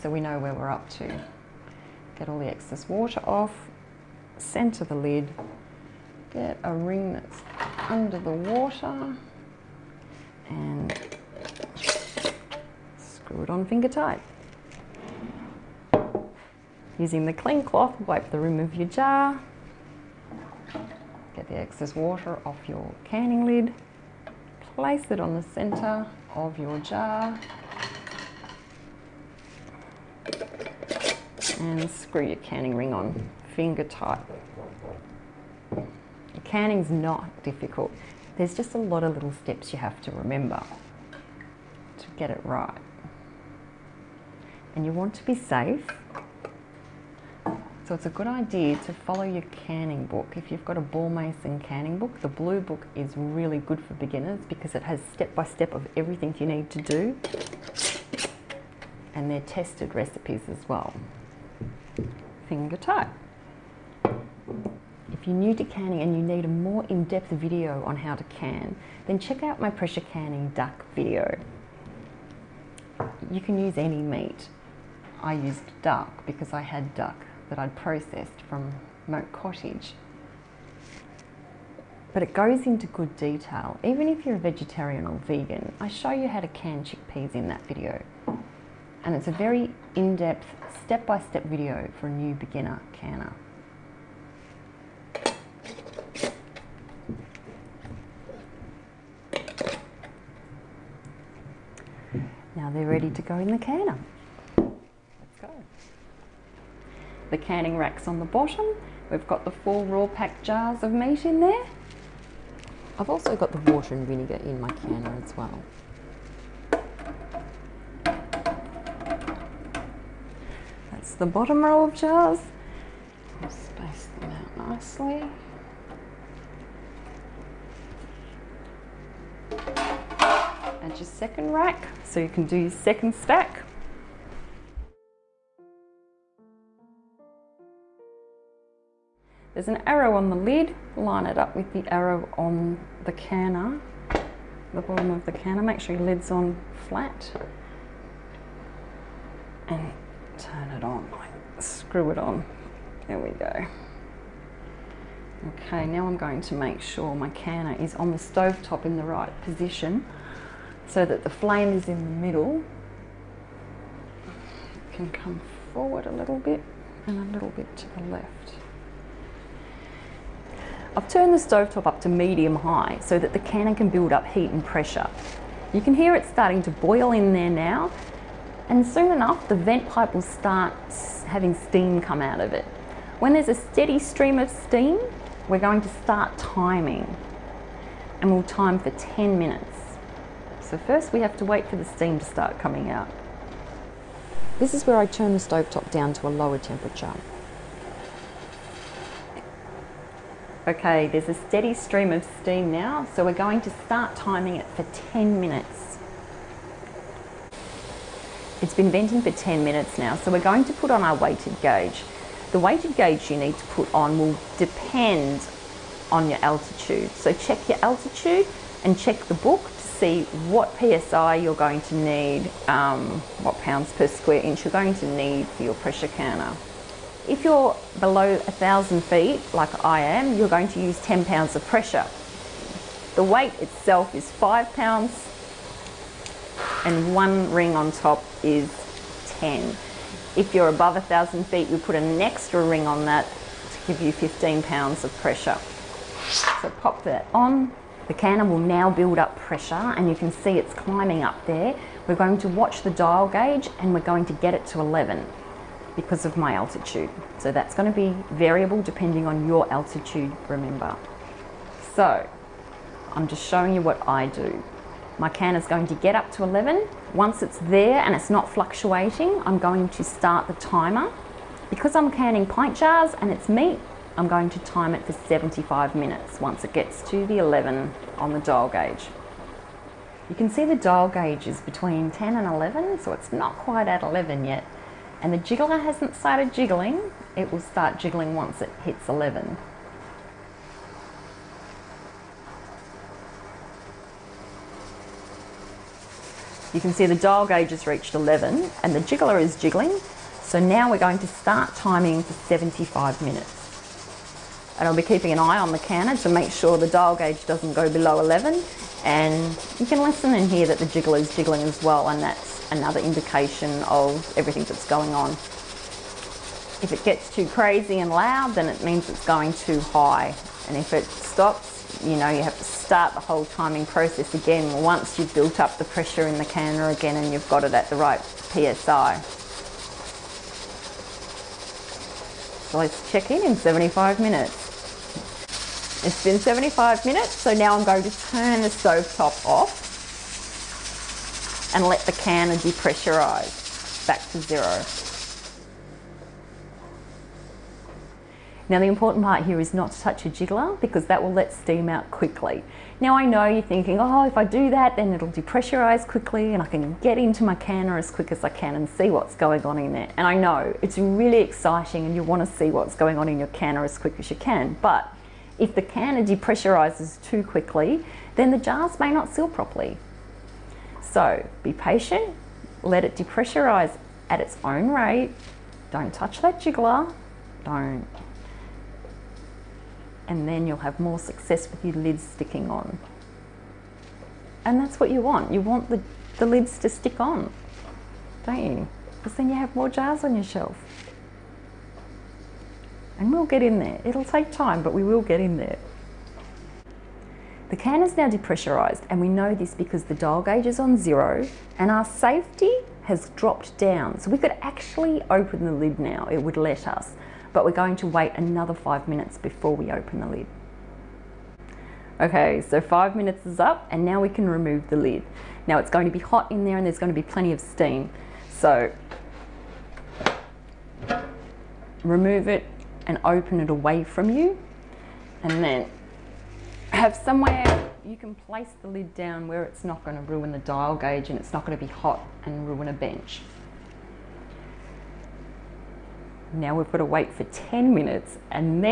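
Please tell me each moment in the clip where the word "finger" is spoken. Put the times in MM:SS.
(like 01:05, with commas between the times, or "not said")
00:13, 00:33, 01:02.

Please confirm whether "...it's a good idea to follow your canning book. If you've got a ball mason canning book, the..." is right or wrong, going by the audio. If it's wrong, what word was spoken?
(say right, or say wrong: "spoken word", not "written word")
right.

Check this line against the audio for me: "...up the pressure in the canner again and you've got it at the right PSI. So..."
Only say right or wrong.
right.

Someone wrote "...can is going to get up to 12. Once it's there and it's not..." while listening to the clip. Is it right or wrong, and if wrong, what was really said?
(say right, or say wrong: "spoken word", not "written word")
wrong: "11", not "12".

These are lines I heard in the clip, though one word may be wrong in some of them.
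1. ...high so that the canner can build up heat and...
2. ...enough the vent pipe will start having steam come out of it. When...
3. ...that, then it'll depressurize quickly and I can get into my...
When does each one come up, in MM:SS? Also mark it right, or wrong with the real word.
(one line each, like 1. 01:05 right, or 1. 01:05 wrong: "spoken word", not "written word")
1. 02:52 right
2. 02:59 right
3. 05:54 right.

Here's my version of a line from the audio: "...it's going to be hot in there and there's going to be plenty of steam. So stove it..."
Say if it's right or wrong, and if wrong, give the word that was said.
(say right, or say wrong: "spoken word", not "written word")
wrong: "remove", not "stove".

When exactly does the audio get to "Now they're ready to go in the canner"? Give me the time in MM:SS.
01:42.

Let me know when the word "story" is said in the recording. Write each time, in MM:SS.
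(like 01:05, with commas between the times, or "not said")
not said.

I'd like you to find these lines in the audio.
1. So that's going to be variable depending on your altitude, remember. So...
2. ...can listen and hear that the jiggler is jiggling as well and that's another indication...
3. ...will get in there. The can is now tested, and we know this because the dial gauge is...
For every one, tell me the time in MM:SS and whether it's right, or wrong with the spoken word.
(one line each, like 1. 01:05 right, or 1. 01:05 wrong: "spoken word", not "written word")
1. 04:17 right
2. 05:09 right
3. 06:35 wrong: "depressurised", not "tested".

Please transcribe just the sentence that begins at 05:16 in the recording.
If it gets too crazy and loud, then it means it's going too high.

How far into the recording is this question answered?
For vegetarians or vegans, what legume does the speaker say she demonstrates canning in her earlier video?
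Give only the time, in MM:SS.
01:26.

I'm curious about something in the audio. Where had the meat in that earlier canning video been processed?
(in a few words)
Moat Cottage.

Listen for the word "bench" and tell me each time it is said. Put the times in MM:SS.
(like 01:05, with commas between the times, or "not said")
07:12.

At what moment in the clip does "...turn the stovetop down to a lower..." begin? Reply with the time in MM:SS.
03:15.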